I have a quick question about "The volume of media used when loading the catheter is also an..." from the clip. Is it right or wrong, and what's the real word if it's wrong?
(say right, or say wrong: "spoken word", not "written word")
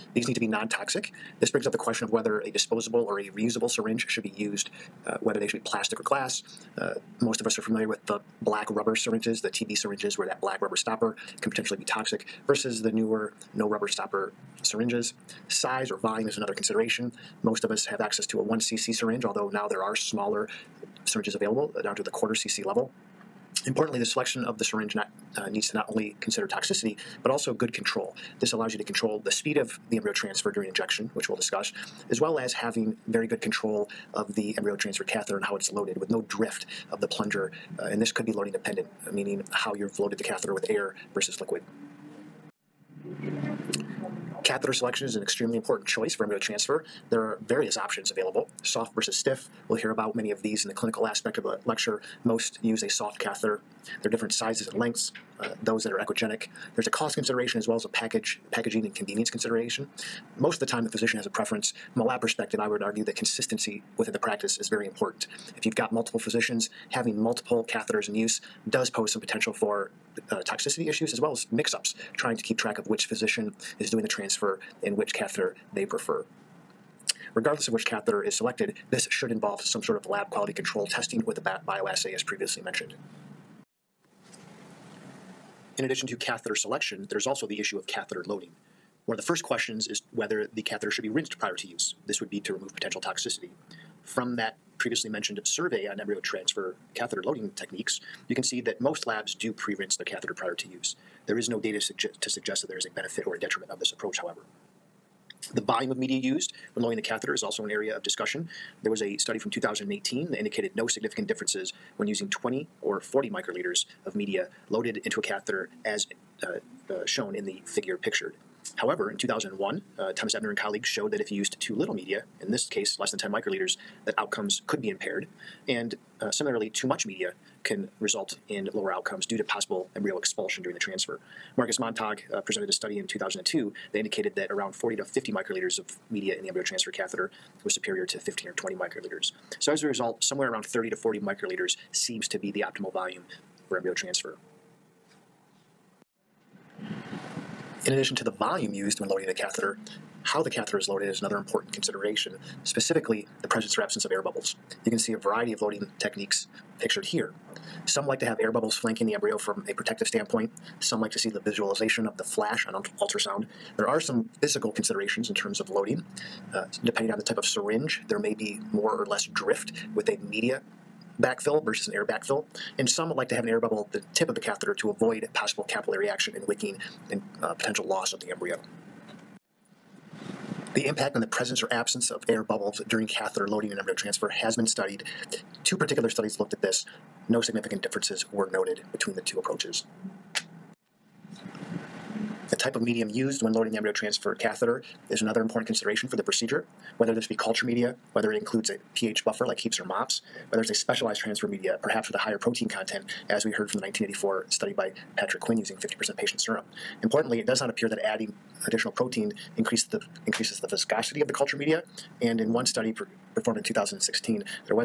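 right.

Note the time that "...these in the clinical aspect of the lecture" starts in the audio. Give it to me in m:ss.
0:50.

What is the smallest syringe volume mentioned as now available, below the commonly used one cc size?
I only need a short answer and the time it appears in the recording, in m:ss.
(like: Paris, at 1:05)
quarter cc, at 0:22.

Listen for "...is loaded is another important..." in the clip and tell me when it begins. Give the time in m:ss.
2:30.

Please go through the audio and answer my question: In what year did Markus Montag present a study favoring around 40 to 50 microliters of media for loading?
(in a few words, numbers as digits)
2002.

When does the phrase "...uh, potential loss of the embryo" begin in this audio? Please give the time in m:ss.
2:57.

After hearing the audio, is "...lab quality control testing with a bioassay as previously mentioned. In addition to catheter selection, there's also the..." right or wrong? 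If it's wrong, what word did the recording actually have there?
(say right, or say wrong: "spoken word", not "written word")
right.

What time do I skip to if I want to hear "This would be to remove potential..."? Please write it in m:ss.
1:32.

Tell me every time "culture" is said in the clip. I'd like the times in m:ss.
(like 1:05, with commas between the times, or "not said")
3:17, 3:31.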